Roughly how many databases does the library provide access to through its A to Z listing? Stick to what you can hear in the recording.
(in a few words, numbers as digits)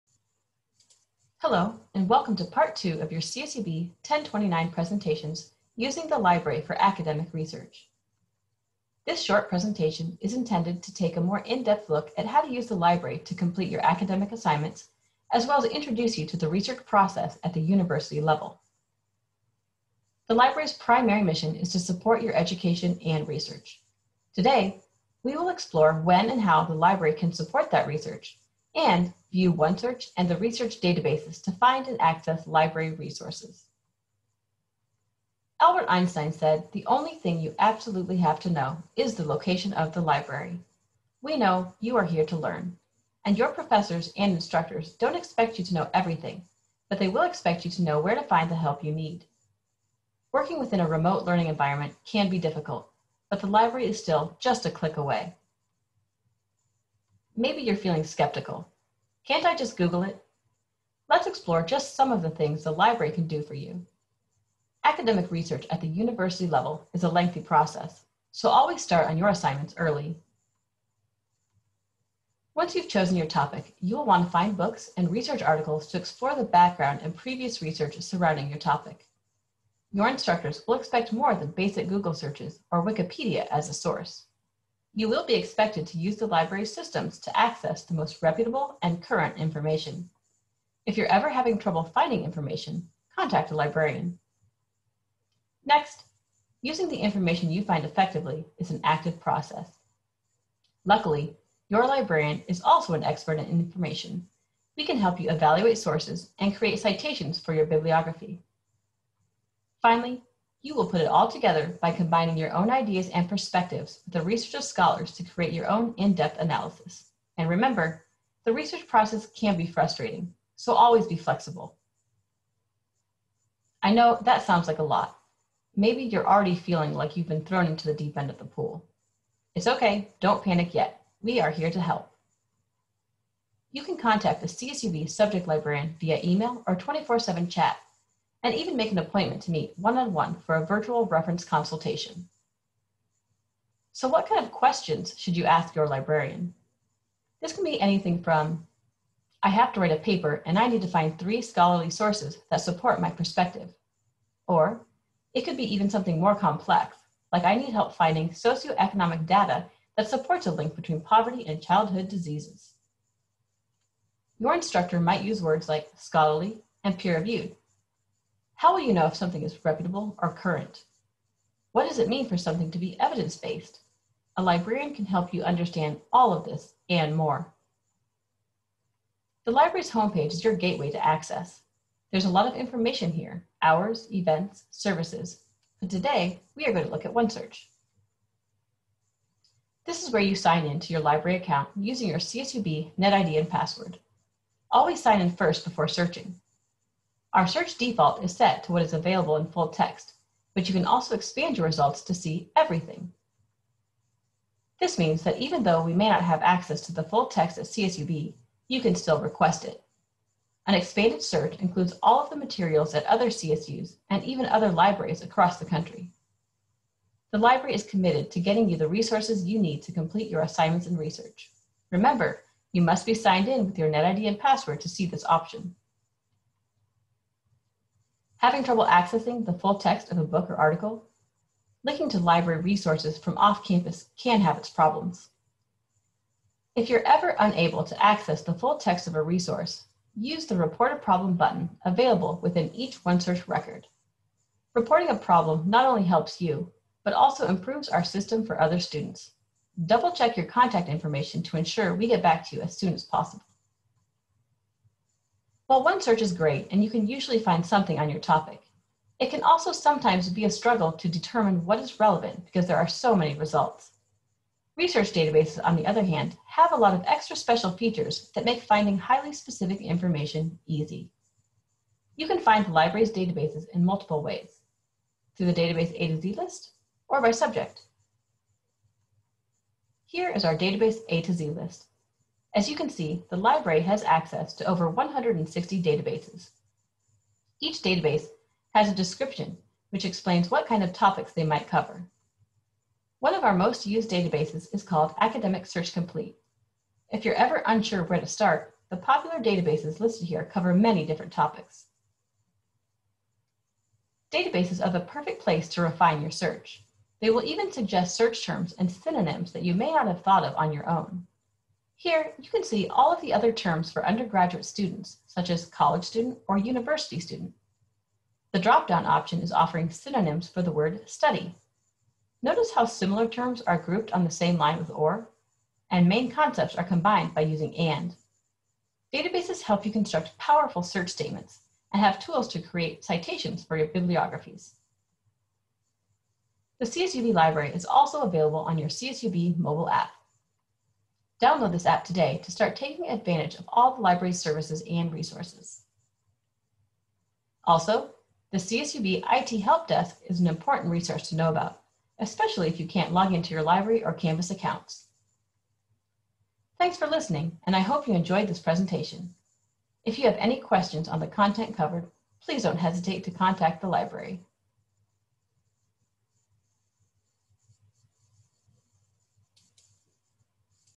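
over 160.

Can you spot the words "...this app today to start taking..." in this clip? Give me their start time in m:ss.
5:41.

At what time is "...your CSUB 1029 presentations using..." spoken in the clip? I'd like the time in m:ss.
0:03.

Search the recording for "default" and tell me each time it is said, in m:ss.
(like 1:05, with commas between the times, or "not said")
3:17.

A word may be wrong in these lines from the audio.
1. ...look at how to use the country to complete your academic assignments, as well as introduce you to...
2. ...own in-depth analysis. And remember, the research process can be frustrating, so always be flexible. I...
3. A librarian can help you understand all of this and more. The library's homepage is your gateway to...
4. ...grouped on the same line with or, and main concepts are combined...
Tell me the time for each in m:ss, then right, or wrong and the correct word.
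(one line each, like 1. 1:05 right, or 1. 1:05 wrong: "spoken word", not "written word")
1. 0:11 wrong: "library", not "country"
2. 1:55 right
3. 2:54 right
4. 5:23 right.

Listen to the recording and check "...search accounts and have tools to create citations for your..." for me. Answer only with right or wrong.
wrong.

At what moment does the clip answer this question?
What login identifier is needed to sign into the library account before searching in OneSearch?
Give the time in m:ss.
3:12.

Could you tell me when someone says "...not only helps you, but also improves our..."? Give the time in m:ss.
4:05.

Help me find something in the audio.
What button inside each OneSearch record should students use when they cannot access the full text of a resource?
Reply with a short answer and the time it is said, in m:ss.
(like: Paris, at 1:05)
Report a Problem, at 4:00.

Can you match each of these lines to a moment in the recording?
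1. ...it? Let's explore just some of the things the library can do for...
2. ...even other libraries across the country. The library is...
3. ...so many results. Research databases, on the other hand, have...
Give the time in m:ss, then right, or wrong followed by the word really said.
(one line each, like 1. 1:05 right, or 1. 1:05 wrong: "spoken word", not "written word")
1. 1:00 right
2. 3:34 right
3. 4:22 right.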